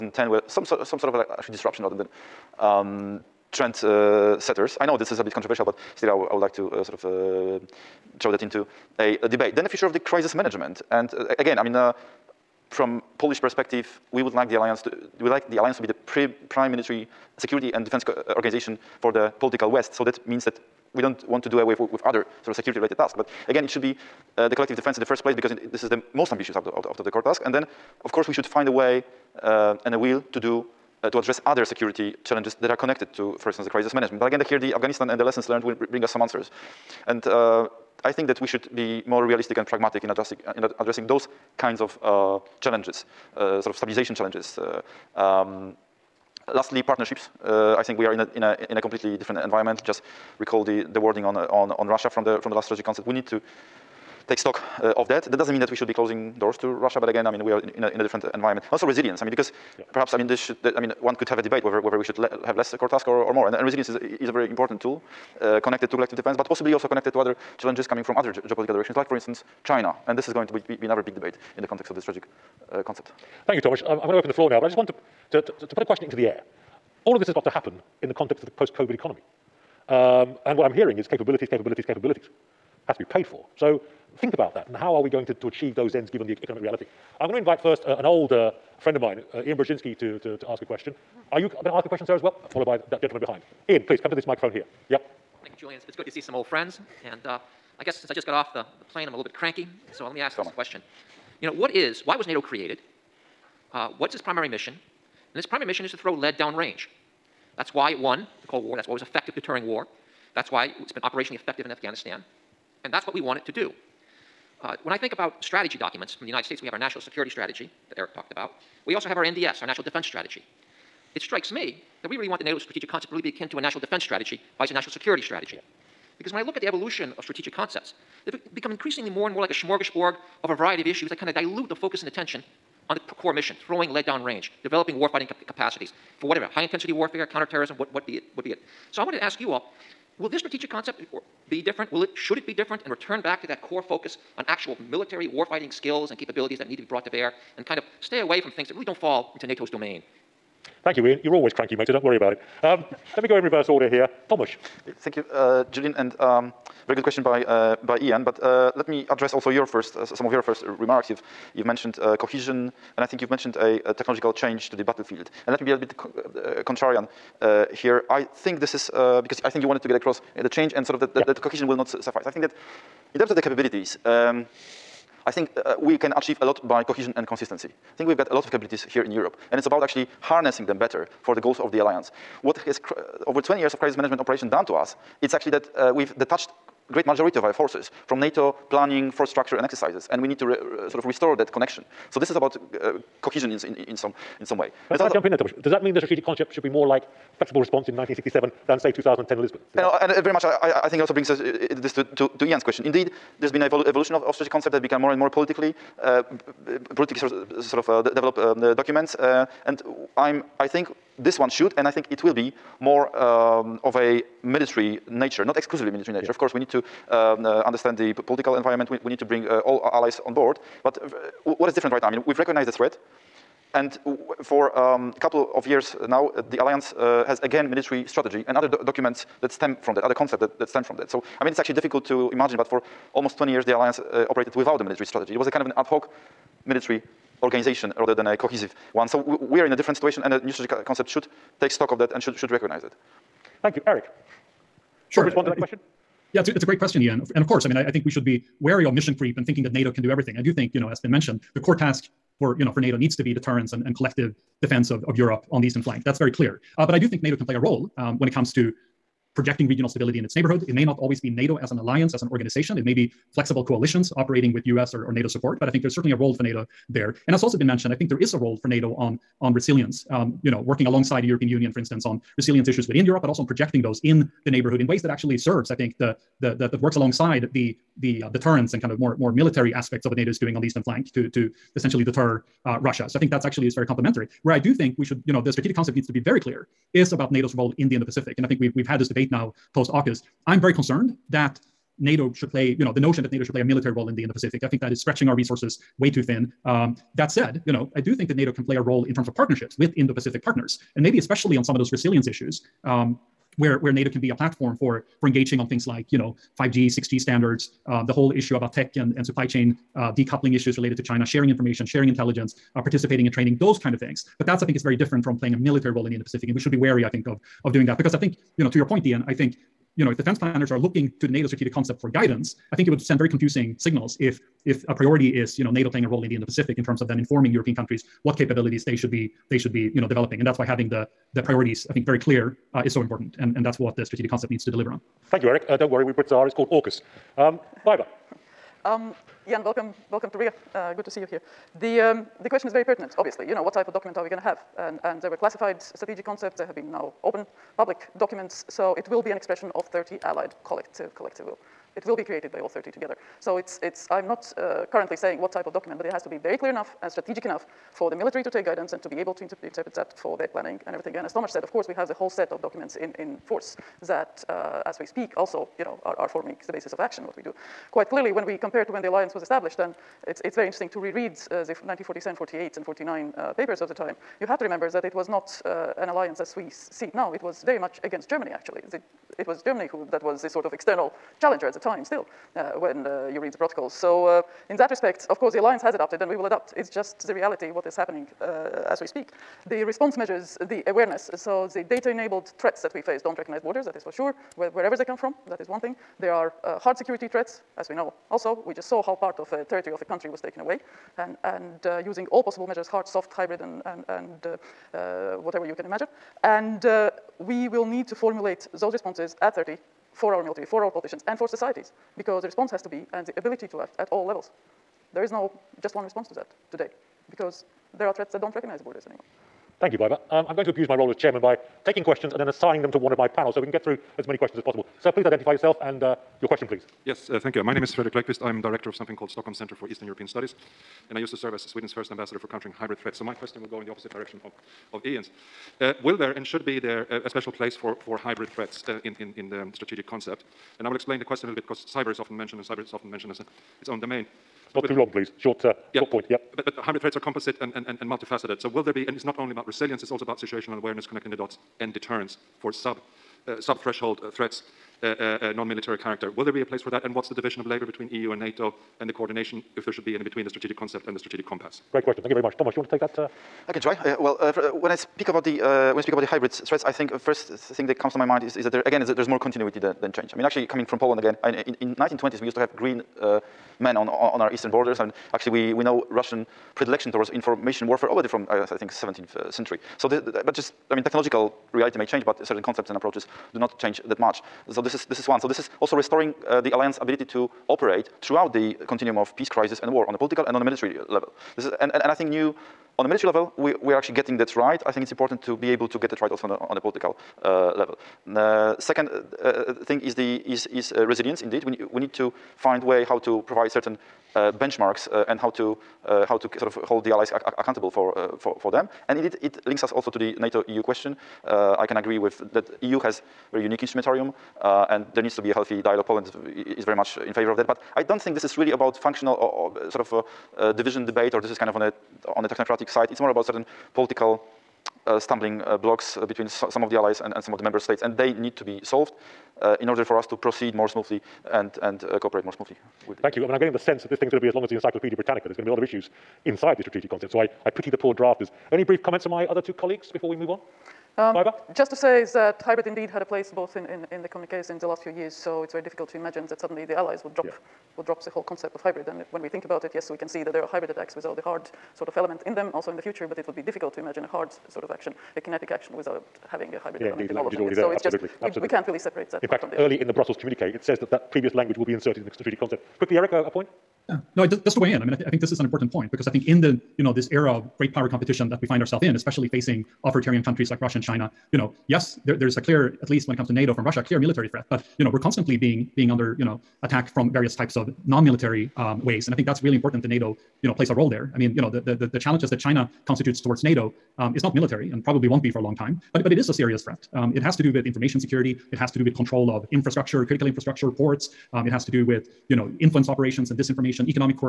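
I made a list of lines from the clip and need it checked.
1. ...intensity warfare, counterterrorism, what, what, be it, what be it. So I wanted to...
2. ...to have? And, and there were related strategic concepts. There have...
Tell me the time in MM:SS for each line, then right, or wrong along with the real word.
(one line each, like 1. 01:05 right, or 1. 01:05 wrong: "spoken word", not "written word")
1. 02:16 right
2. 05:44 wrong: "classified", not "related".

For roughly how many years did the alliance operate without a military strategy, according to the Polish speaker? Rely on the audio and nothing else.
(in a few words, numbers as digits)
20 years.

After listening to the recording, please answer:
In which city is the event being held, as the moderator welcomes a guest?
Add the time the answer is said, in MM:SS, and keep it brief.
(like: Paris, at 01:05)
Riga, at 05:40.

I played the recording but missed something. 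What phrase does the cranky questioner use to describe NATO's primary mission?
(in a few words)
Throw lead downrange.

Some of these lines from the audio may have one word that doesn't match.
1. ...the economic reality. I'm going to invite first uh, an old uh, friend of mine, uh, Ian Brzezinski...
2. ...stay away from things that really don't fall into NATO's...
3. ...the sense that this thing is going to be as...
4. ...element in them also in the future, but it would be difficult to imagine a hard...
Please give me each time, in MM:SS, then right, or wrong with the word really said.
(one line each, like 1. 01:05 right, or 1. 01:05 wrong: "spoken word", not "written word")
1. 01:26 right
2. 02:28 right
3. 08:53 right
4. 09:12 right.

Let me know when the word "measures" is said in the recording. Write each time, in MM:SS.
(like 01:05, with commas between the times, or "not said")
06:30, 06:42.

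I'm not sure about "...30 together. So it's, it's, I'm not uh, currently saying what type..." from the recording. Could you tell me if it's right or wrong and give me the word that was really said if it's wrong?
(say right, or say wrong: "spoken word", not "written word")
right.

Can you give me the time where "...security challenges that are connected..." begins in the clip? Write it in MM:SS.
00:31.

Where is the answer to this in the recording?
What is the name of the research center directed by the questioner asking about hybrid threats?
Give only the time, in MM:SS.
07:09.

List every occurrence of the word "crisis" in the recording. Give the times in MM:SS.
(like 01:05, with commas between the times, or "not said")
00:09, 00:33, 03:03, 08:09.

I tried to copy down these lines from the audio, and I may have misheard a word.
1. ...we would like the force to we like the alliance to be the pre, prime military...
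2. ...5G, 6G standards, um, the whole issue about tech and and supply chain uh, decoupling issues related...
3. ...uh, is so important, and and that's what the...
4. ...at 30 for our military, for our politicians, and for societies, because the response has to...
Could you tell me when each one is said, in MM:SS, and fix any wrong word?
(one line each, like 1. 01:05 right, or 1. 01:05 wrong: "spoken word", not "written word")
1. 00:14 wrong: "alliance", not "force"
2. 05:06 right
3. 05:32 right
4. 06:49 right.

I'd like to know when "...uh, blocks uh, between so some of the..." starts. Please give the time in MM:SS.
08:45.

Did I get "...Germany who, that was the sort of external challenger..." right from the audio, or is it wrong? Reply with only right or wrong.
right.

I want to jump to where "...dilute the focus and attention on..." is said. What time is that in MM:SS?
02:11.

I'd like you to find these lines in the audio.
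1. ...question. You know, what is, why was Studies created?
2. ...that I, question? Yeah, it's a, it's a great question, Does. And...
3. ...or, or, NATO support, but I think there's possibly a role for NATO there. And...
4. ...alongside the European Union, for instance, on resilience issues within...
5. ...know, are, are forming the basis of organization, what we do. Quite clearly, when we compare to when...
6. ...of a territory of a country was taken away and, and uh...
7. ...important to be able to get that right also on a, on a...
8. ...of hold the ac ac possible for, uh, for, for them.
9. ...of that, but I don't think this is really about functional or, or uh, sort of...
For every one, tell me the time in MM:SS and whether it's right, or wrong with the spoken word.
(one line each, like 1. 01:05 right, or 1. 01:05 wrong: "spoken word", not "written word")
1. 01:40 wrong: "NATO", not "Studies"
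2. 04:05 wrong: "Ian", not "Does"
3. 04:24 wrong: "certainly", not "possibly"
4. 04:30 right
5. 06:05 wrong: "action", not "organization"
6. 06:39 right
7. 08:15 right
8. 08:26 wrong: "accountable", not "possible"
9. 08:37 right.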